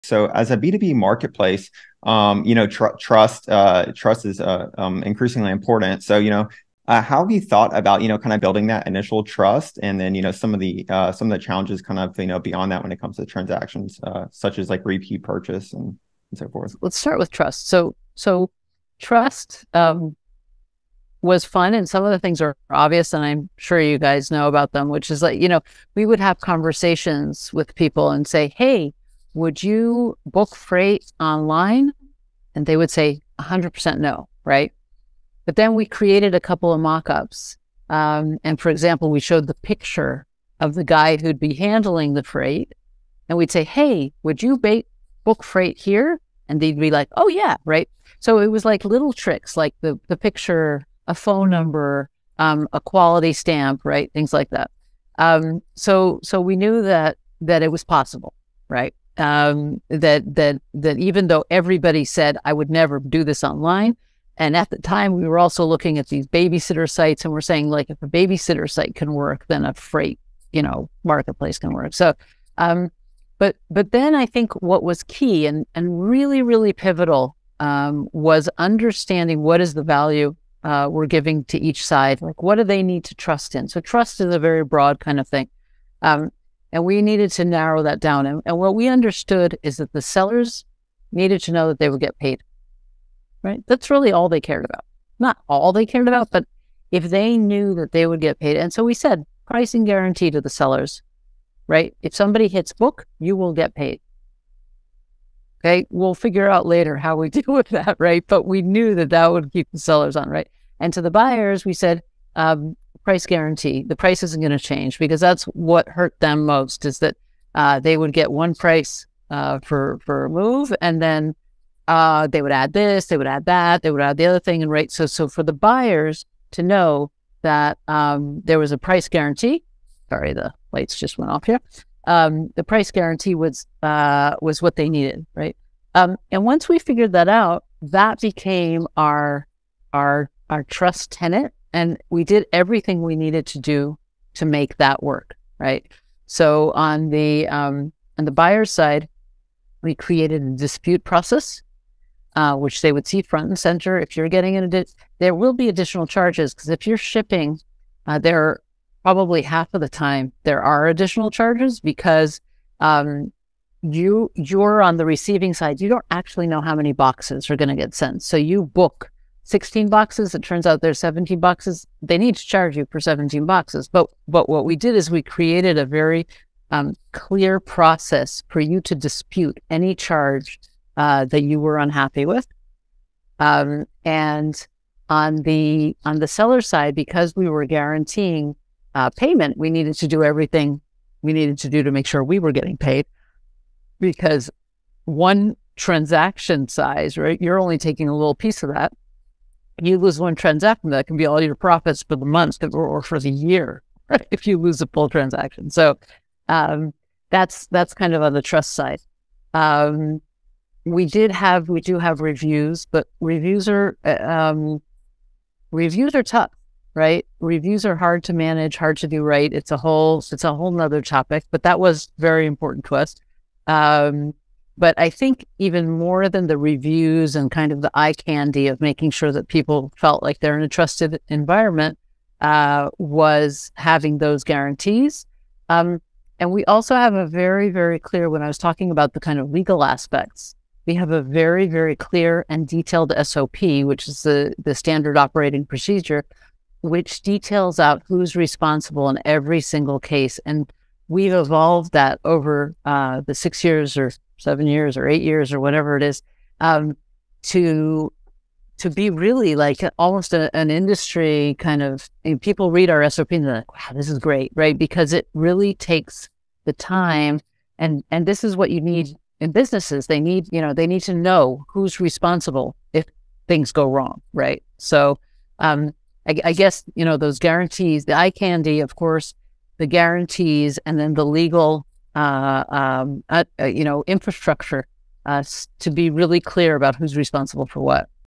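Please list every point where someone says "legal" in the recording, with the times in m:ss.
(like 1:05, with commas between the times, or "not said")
3:59, 4:41.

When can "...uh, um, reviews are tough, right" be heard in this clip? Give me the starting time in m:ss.
3:34.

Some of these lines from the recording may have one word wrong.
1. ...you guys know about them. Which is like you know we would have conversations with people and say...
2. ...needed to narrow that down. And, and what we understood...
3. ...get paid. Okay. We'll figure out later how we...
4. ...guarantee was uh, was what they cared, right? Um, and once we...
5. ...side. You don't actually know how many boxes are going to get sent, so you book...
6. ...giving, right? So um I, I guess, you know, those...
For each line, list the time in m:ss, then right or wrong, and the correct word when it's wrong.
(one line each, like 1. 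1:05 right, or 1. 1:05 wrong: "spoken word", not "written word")
1. 0:23 right
2. 1:27 right
3. 1:43 right
4. 2:12 wrong: "needed", not "cared"
5. 2:45 right
6. 4:33 wrong: "wrong", not "giving".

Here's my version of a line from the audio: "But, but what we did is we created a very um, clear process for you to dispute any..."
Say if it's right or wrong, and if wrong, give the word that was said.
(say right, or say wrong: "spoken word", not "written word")
right.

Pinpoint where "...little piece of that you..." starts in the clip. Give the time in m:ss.
3:18.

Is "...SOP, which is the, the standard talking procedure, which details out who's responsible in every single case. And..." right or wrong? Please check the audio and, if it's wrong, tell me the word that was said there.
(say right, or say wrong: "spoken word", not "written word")
wrong: "operating", not "talking".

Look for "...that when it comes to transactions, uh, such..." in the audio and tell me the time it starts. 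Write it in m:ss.
0:12.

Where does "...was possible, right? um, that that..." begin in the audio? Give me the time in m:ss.
0:57.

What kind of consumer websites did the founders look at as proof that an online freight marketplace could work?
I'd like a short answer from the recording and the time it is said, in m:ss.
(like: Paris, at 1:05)
Babysitter sites, at 1:06.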